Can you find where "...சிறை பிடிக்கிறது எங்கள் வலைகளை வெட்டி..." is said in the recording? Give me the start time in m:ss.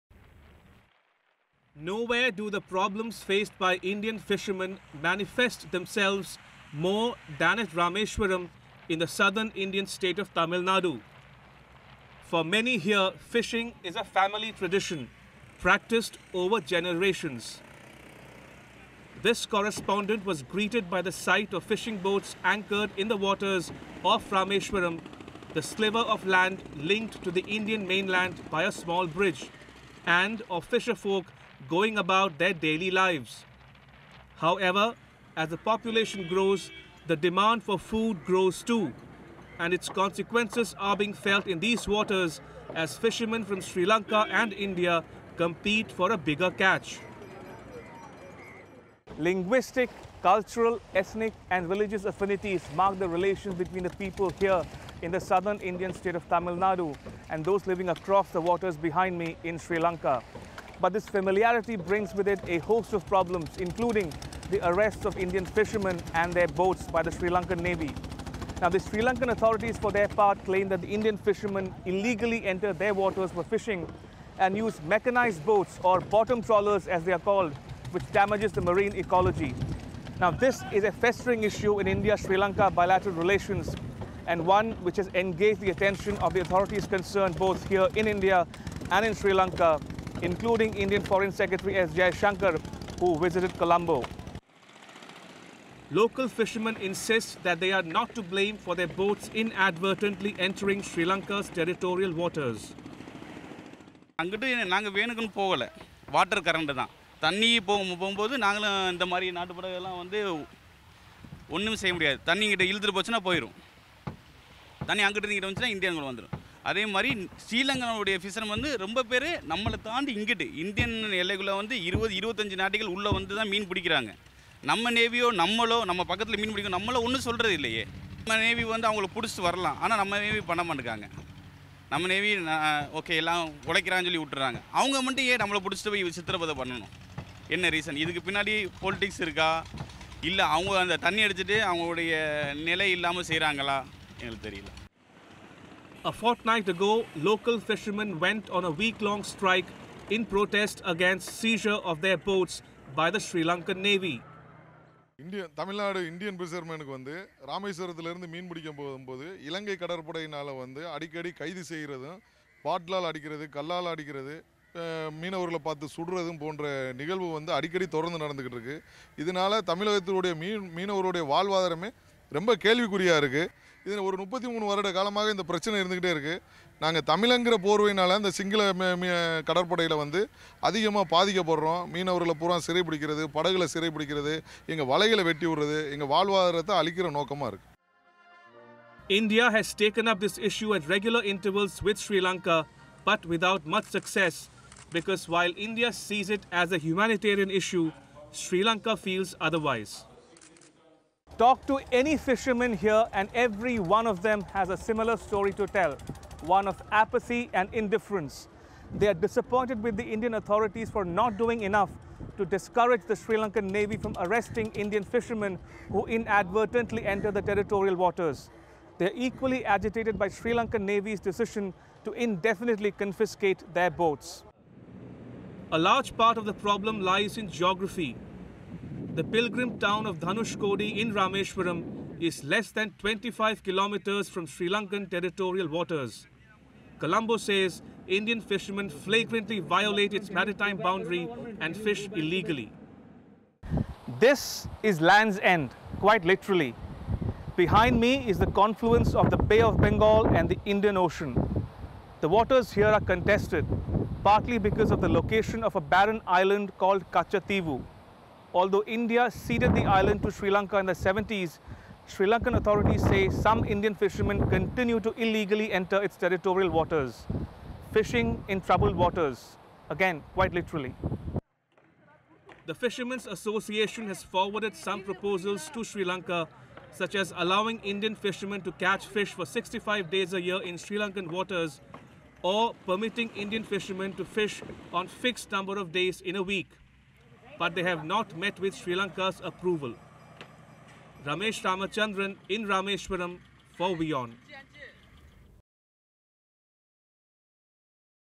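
3:03.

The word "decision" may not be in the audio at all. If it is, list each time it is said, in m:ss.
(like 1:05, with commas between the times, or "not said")
3:41.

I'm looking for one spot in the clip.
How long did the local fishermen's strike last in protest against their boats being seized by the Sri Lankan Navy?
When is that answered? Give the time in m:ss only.
2:28.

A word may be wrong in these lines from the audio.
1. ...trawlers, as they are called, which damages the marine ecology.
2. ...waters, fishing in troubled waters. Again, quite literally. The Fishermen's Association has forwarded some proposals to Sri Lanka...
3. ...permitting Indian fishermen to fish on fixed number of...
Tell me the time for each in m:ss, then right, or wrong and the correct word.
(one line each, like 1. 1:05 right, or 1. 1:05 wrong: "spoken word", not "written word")
1. 1:16 right
2. 4:26 right
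3. 4:42 right.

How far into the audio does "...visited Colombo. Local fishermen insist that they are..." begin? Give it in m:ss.
1:33.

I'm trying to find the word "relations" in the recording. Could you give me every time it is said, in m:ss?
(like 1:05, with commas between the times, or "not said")
0:53, 1:23.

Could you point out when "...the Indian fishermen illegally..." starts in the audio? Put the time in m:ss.
1:10.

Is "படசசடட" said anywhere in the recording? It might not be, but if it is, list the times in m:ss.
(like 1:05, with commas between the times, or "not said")
2:09, 2:15.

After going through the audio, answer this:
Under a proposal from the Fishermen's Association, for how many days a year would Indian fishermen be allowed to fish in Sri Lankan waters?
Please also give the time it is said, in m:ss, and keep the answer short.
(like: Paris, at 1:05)
65, at 4:39.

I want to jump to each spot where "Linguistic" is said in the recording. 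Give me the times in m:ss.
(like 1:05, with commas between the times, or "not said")
0:49.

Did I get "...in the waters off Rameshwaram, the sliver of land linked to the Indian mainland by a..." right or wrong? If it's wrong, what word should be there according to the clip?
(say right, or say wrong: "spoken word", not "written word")
right.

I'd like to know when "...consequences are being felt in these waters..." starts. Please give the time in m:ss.
0:39.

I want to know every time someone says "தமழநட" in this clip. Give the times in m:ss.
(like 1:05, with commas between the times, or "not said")
2:35.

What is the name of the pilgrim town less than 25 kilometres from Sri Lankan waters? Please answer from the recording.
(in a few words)
Dhanushkodi.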